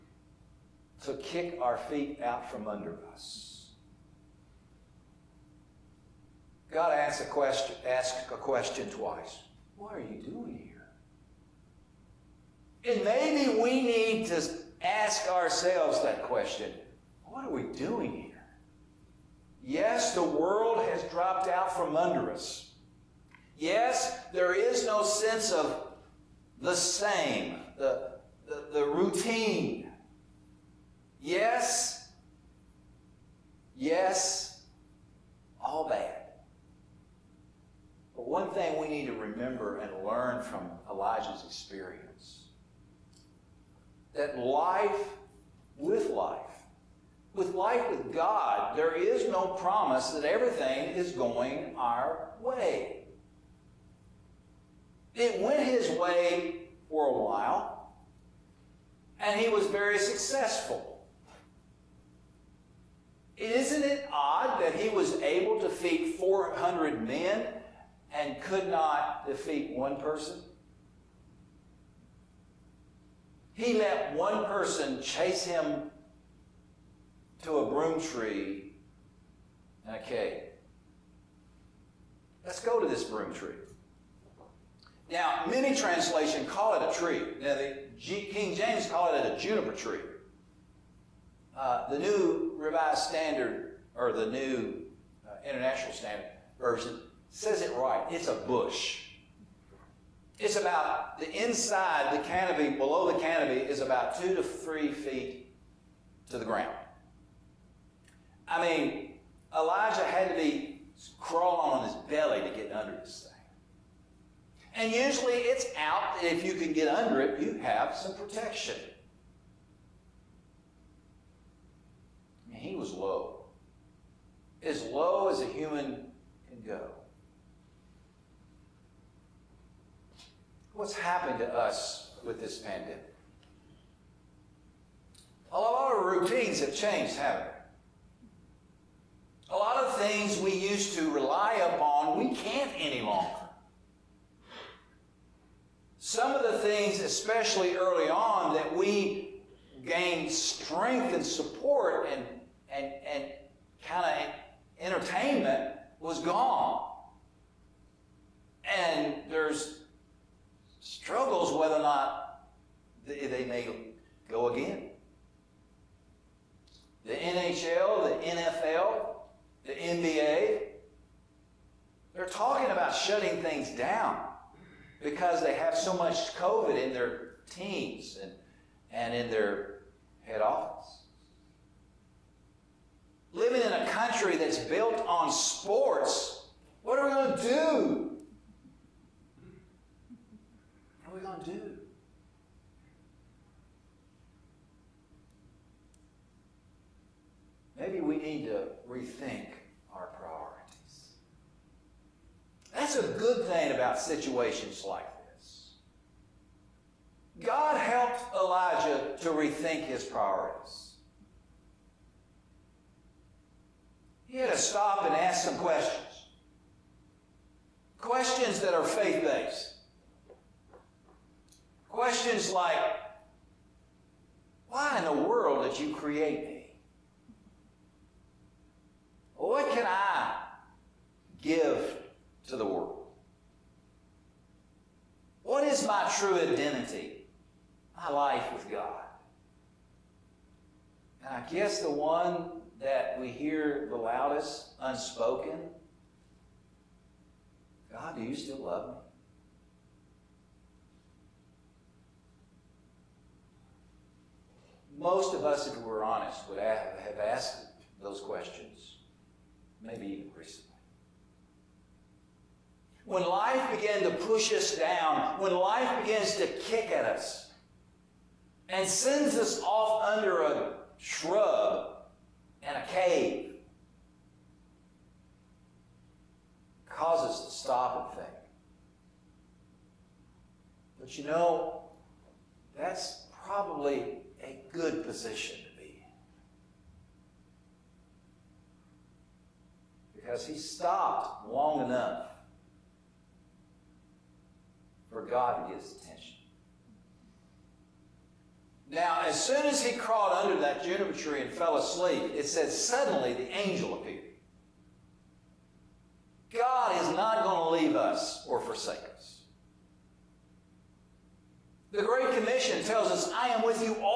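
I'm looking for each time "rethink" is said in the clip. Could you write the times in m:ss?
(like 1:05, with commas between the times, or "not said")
3:18, 3:29.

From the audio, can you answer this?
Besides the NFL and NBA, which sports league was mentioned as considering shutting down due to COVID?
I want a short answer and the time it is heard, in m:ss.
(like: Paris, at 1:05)
NHL, at 2:47.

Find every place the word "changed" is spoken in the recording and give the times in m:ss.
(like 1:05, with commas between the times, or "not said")
2:16.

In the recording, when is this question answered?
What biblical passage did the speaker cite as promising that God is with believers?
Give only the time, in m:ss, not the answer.
5:11.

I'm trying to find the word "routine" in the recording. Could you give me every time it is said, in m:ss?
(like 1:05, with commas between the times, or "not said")
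0:28, 2:16.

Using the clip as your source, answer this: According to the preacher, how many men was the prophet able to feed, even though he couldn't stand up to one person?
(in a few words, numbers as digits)
400.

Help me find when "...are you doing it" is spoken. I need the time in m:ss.
0:09.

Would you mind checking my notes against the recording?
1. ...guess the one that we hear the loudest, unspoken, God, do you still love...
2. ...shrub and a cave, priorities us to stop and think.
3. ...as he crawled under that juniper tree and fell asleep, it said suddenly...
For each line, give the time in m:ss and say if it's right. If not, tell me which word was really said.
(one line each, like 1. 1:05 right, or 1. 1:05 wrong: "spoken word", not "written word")
1. 4:01 right
2. 4:30 wrong: "causes", not "priorities"
3. 4:59 right.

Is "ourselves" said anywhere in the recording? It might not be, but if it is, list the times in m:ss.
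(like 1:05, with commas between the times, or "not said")
0:15.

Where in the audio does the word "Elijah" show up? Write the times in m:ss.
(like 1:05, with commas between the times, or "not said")
0:40, 1:49, 3:28.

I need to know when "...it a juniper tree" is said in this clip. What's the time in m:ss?
1:29.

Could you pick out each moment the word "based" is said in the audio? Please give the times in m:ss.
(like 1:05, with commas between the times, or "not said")
3:39.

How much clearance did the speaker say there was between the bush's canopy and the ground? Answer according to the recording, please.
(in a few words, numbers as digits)
2 to 3 feet.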